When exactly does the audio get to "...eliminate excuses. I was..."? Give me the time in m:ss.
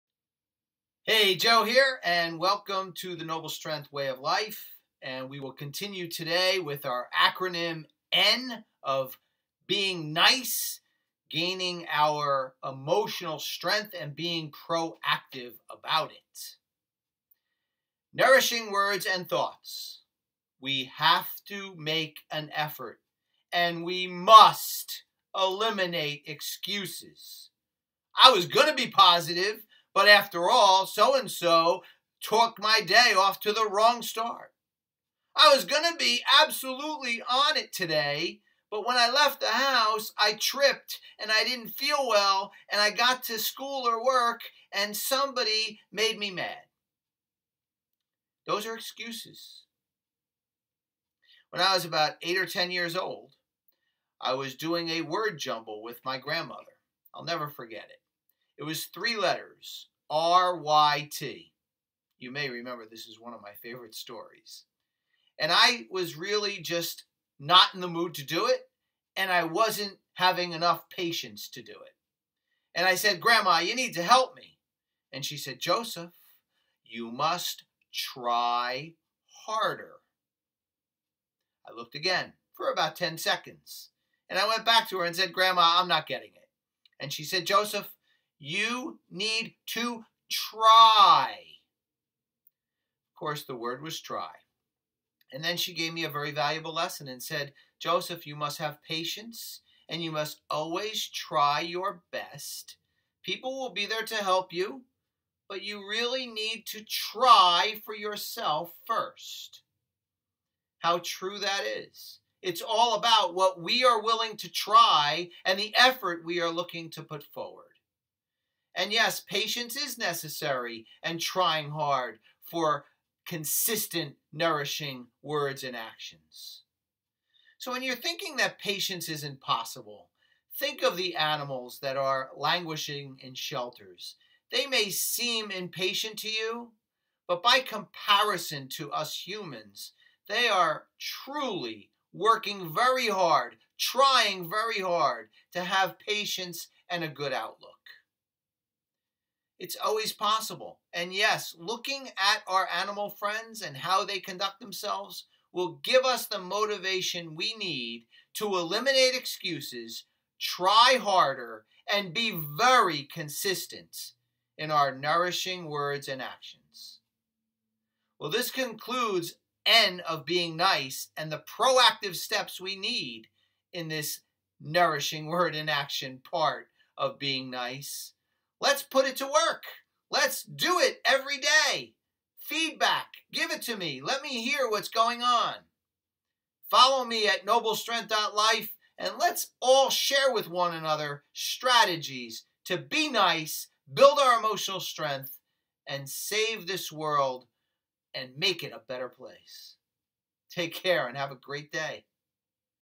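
0:25.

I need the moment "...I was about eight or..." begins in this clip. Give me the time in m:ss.
0:51.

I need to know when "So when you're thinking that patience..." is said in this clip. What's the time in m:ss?
2:07.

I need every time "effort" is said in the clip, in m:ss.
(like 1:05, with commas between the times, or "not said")
0:22, 1:55.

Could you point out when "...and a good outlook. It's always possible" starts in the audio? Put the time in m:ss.
2:26.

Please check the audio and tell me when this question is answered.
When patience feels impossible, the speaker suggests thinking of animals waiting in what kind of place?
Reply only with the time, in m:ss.
2:13.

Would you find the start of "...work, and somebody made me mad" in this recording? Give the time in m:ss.
0:44.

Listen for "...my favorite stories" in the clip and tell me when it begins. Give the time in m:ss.
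1:03.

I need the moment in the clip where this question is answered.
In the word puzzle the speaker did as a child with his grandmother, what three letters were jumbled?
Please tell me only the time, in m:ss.
1:00.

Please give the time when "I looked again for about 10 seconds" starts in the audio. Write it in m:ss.
1:21.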